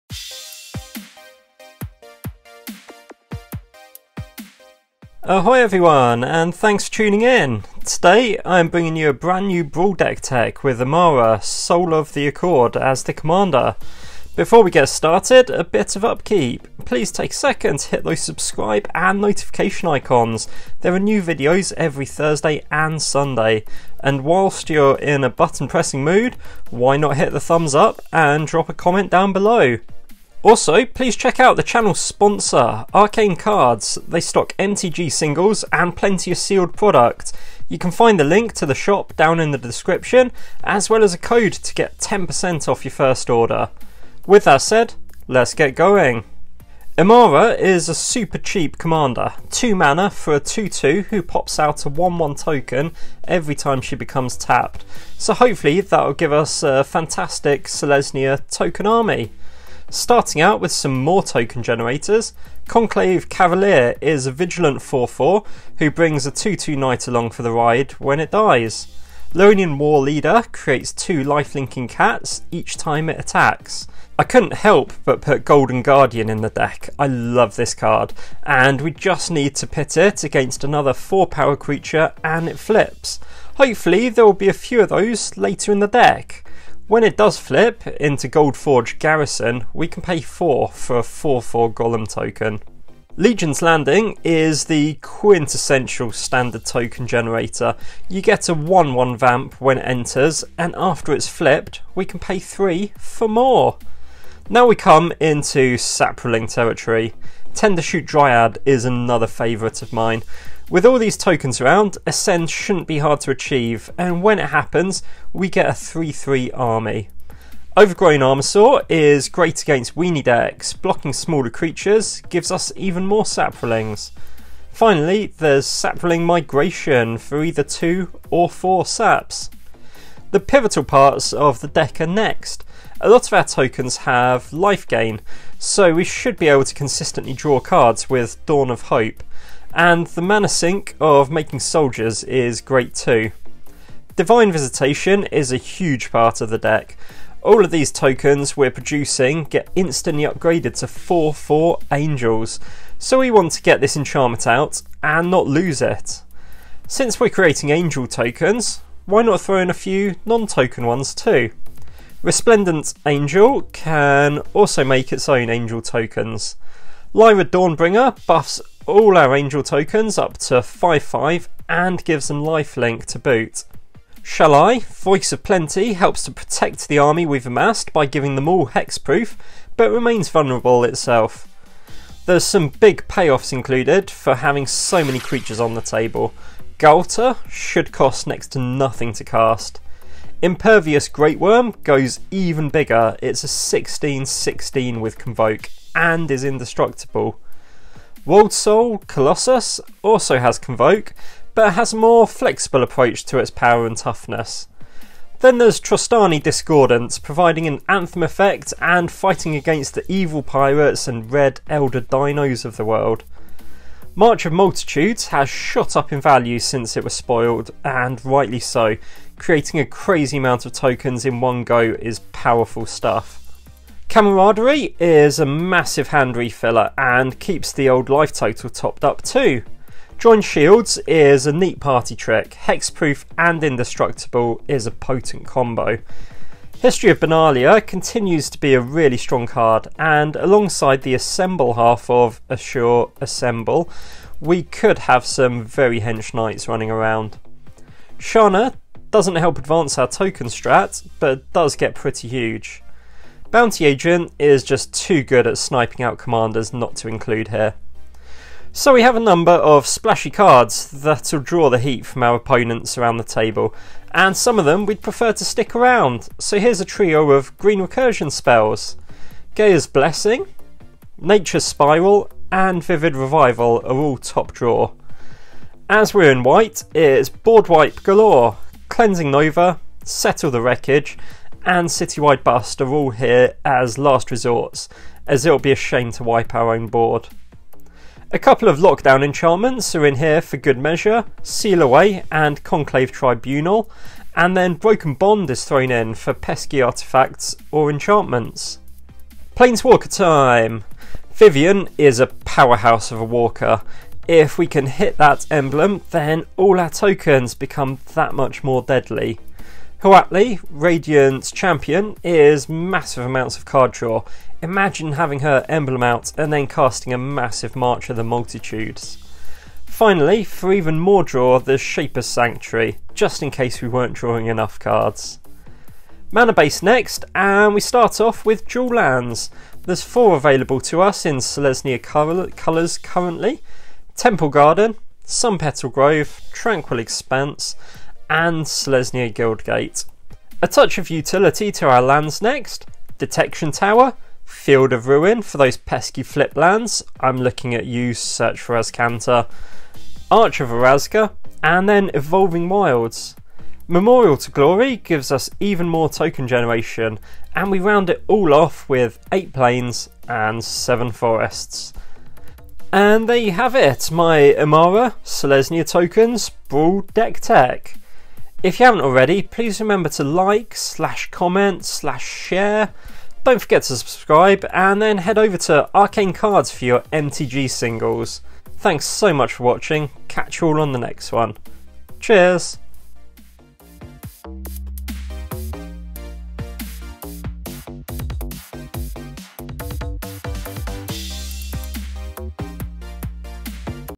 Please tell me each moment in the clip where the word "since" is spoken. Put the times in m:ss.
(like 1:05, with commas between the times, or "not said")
2:36, 3:36.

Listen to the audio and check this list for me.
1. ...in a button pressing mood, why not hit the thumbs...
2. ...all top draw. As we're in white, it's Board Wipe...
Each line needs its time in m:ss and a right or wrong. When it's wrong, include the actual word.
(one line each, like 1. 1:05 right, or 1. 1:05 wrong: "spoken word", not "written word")
1. 0:24 right
2. 4:33 right.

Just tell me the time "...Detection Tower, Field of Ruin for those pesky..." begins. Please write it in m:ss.
5:43.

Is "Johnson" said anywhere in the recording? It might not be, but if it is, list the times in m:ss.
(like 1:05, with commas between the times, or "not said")
not said.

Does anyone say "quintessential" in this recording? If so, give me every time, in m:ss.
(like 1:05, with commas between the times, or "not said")
1:34.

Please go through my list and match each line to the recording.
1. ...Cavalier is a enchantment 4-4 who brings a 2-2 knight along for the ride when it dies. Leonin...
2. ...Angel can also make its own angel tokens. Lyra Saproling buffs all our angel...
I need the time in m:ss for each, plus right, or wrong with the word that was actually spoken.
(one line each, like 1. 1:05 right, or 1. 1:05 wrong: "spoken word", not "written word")
1. 1:03 wrong: "vigilant", not "enchantment"
2. 2:43 wrong: "Dawnbringer", not "Saproling".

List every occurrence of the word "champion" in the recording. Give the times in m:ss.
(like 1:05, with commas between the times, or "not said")
5:11.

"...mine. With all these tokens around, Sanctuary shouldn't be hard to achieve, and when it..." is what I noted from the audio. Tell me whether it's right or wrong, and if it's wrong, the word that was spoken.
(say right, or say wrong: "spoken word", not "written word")
wrong: "Ascend", not "Sanctuary".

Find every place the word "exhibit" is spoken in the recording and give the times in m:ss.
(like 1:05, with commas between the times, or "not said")
not said.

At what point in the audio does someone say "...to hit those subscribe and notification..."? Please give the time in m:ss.
0:17.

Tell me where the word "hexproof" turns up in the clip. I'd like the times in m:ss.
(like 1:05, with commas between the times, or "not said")
2:58, 3:52.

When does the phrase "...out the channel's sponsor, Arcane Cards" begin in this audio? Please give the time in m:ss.
0:31.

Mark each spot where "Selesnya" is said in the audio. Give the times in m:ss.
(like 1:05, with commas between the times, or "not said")
0:57, 5:31, 5:38, 6:05.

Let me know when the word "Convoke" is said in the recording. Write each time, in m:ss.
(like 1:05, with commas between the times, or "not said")
3:15, 3:20.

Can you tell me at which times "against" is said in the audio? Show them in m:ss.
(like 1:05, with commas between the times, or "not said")
1:20, 1:59, 3:29.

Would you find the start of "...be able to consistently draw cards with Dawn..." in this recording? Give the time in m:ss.
2:16.